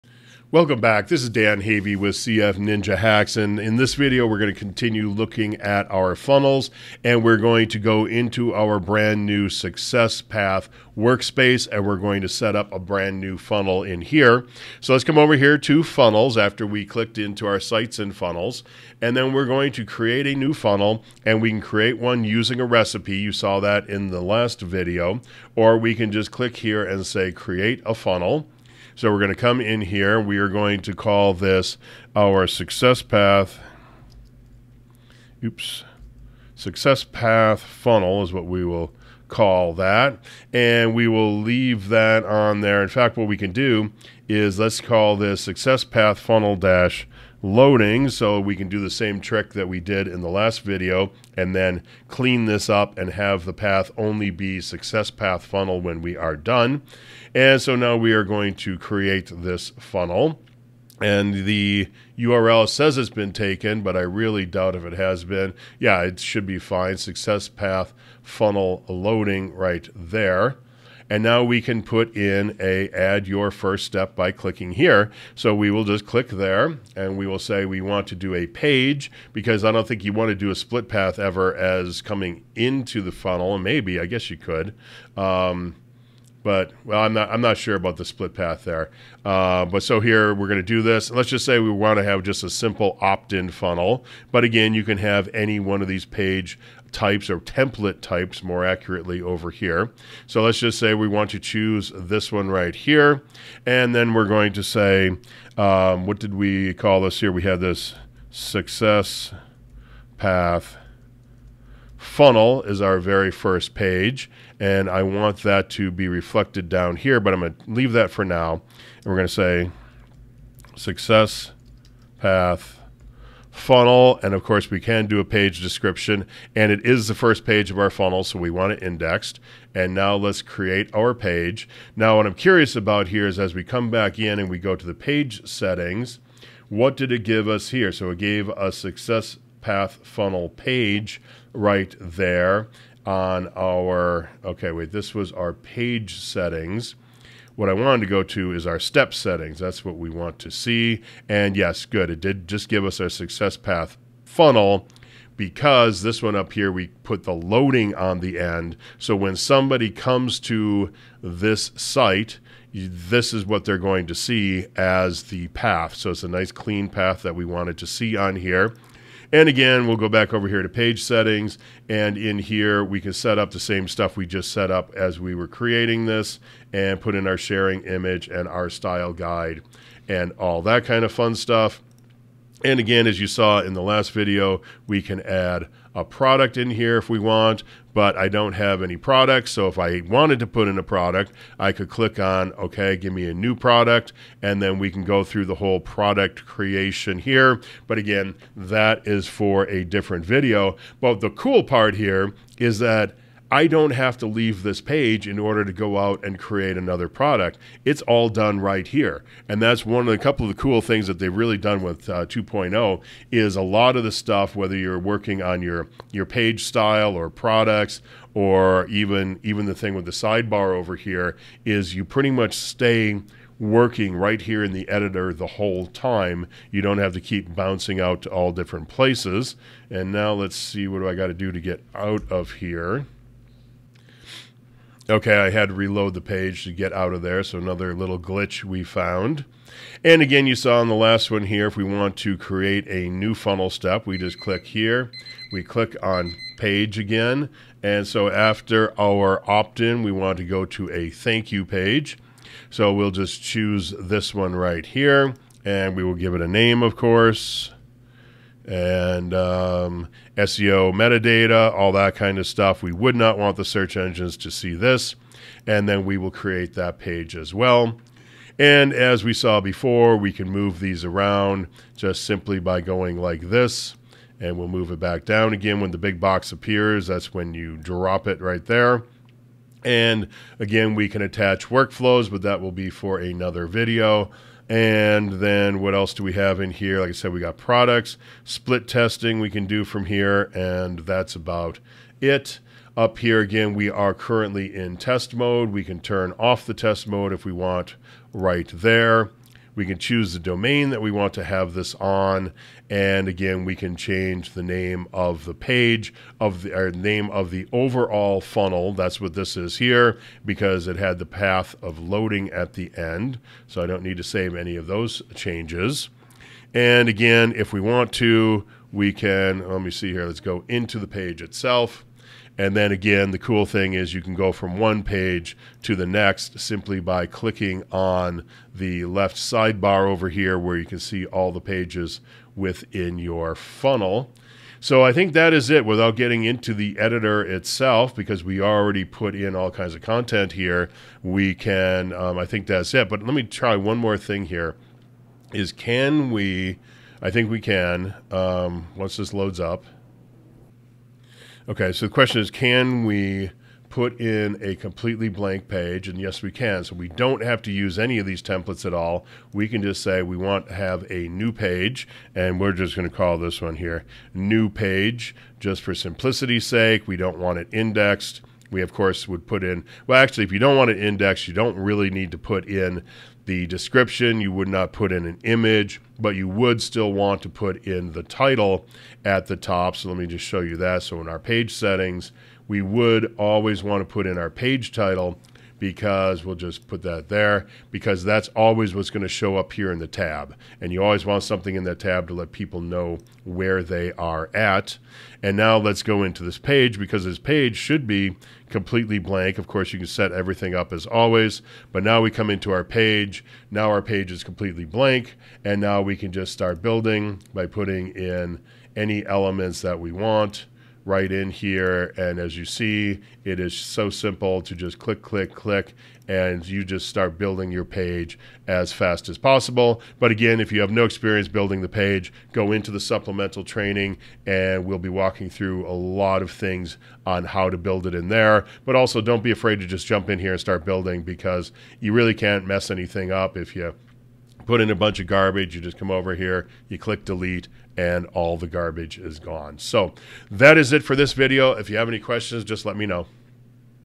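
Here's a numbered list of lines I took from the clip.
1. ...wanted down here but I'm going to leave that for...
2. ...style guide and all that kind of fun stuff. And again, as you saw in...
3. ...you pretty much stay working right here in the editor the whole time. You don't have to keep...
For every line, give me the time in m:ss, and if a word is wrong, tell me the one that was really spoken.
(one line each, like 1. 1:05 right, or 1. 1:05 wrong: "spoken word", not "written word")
1. 1:56 wrong: "reflected", not "wanted"
2. 2:58 right
3. 3:41 right.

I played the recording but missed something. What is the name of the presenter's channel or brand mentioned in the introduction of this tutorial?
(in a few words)
CF Ninja Hacks.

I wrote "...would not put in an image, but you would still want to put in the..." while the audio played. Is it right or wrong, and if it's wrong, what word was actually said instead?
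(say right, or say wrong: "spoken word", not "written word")
right.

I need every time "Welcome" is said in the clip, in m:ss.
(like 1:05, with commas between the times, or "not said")
0:00.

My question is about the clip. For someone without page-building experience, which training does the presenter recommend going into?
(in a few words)
supplemental training.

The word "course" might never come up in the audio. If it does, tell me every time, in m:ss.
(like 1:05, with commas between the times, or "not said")
2:04, 4:16, 6:08, 6:39.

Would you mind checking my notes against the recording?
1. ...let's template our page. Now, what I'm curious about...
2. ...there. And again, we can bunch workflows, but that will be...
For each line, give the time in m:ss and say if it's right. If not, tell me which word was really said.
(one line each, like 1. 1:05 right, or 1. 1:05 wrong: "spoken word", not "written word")
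1. 2:10 wrong: "create", not "template"
2. 4:38 wrong: "attach", not "bunch".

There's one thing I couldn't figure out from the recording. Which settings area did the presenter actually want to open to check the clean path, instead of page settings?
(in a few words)
step settings.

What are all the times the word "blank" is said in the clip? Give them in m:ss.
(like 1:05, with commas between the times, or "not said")
5:55, 6:39, 6:44.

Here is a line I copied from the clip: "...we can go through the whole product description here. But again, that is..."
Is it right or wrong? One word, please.
wrong.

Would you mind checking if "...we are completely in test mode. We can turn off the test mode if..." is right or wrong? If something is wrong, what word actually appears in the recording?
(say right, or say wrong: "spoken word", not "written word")
wrong: "currently", not "completely".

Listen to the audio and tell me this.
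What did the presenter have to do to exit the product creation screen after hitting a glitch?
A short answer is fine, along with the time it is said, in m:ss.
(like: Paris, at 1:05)
reload the page, at 3:55.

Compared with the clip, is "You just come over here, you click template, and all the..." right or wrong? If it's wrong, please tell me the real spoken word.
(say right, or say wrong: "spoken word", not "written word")
wrong: "delete", not "template".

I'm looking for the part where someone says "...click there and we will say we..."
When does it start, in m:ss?
1:16.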